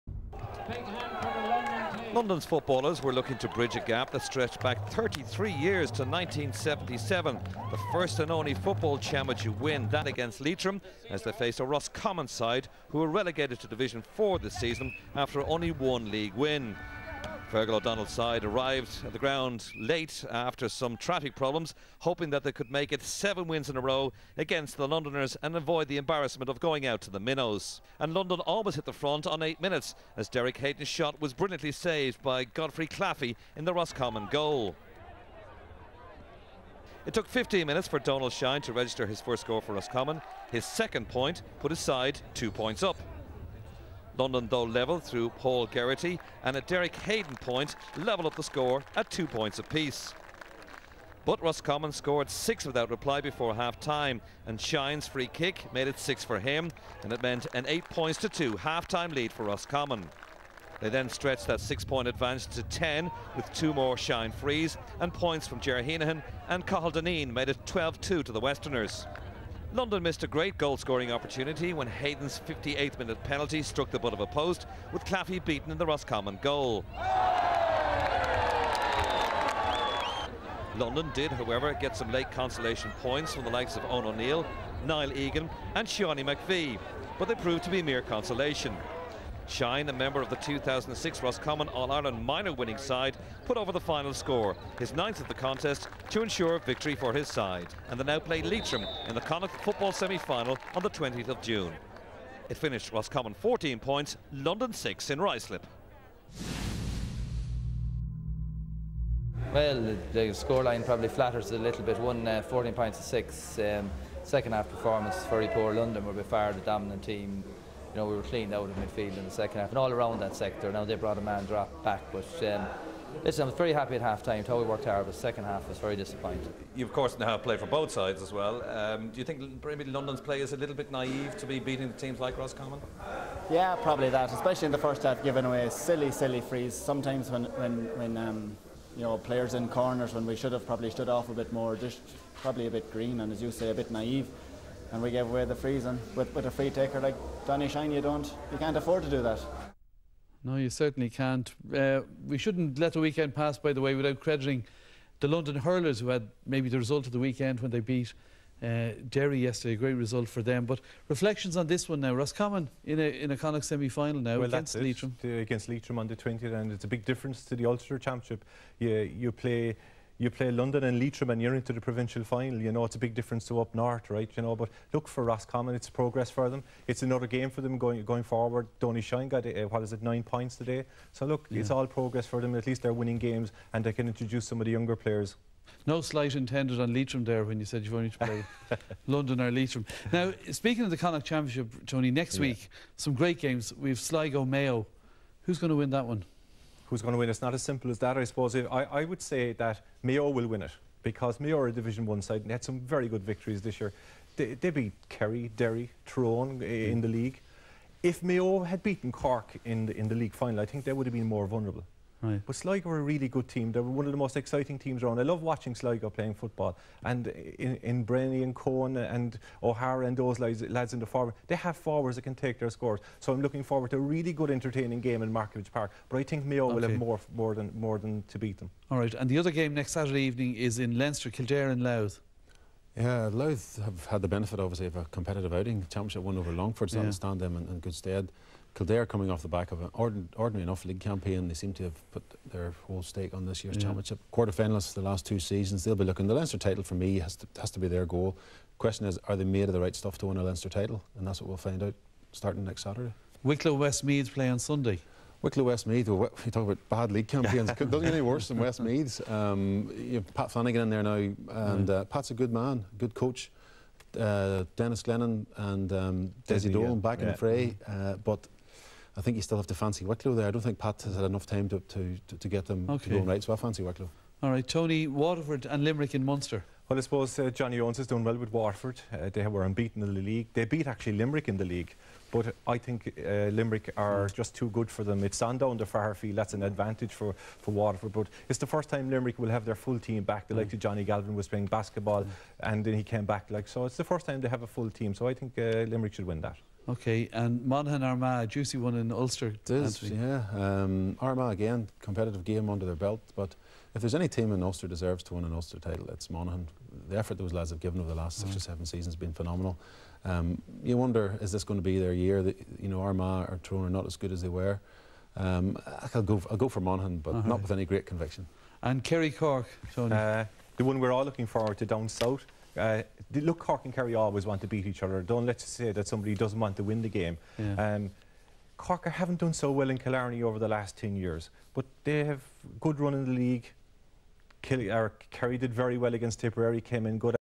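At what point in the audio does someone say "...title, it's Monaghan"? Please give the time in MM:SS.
05:05.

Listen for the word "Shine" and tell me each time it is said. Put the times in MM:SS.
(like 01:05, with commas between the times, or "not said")
00:38, 00:54, 01:03, 01:29, 02:27, 02:59.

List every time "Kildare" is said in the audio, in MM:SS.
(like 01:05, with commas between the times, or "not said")
03:51, 03:58.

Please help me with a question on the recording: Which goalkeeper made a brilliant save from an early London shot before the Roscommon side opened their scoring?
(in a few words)
Geoffrey Claffey.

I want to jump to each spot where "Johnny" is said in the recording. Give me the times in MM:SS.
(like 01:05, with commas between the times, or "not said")
04:37, 04:50.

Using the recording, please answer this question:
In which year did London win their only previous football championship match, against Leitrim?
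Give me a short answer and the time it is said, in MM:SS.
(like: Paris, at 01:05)
1977, at 00:06.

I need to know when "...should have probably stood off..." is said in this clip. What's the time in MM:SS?
02:20.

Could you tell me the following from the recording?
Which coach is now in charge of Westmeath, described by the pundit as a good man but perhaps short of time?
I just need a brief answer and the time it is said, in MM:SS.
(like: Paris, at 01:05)
Pat Flanagan, at 04:20.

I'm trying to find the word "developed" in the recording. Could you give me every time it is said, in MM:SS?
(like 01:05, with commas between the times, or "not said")
not said.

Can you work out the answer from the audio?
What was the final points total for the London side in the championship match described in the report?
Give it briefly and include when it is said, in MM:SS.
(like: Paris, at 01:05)
6, at 01:44.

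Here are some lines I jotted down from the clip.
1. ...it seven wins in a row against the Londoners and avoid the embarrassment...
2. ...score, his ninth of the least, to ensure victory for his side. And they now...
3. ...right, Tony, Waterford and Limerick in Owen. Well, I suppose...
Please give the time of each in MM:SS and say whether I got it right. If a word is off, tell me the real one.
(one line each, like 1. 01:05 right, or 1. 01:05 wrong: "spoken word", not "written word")
1. 00:22 right
2. 01:34 wrong: "contest", not "least"
3. 04:34 wrong: "Munster", not "Owen".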